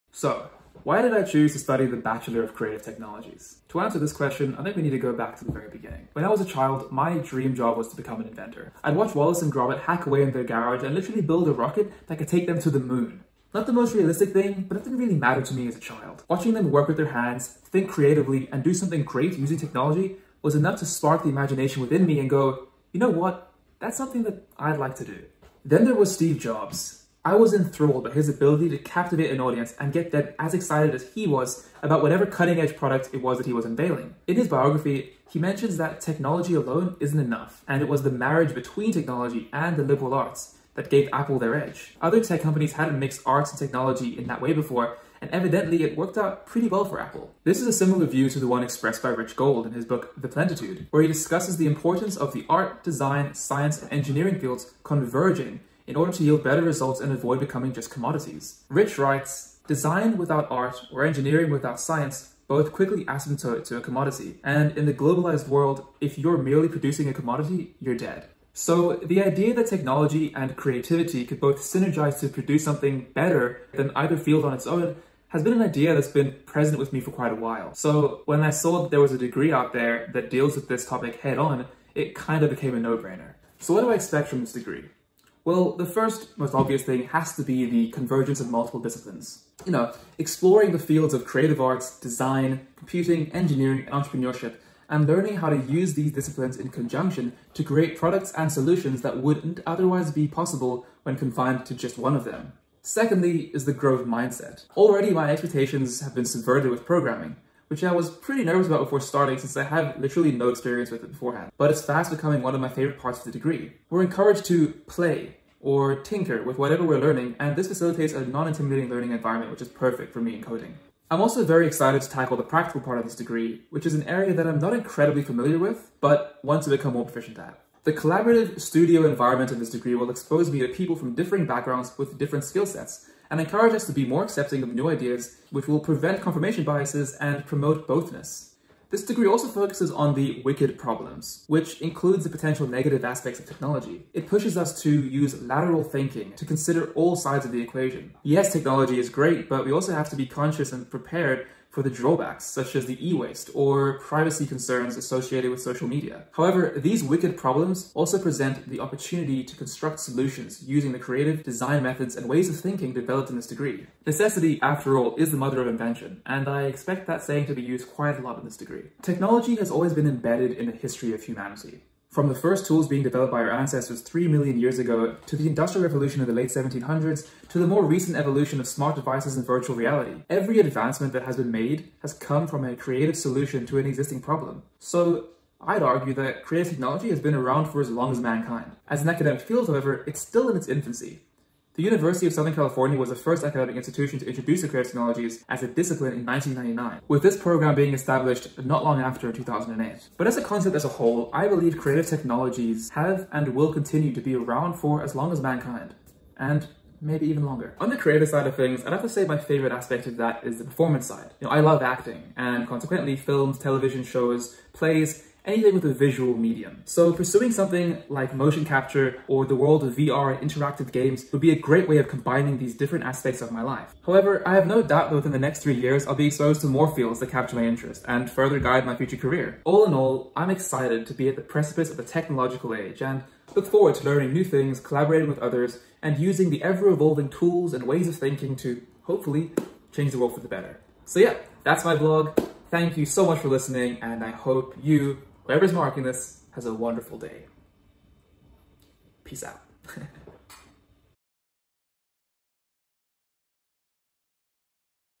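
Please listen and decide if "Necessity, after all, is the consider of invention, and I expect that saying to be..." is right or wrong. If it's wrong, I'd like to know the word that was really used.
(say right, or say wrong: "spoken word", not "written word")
wrong: "mother", not "consider".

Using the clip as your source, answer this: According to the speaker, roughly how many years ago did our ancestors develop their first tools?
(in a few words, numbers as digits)
3 million.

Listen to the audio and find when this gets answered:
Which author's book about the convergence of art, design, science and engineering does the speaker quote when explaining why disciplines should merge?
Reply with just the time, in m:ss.
0:49.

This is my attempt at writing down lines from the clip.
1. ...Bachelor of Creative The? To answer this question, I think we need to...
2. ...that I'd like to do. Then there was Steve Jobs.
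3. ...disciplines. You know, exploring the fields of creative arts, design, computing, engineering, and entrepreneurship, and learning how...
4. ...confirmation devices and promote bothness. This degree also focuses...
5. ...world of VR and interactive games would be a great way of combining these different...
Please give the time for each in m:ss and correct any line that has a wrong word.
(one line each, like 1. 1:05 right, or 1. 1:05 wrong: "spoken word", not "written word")
1. 0:01 wrong: "Technologies", not "The"
2. 0:24 right
3. 1:28 right
4. 2:16 wrong: "biases", not "devices"
5. 3:39 right.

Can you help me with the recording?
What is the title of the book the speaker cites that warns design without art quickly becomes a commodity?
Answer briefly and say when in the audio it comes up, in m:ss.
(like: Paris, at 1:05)
The Plentitude, at 0:50.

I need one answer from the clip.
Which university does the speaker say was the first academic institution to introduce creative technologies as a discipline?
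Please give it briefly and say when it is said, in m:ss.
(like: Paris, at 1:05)
University of Southern California, at 3:11.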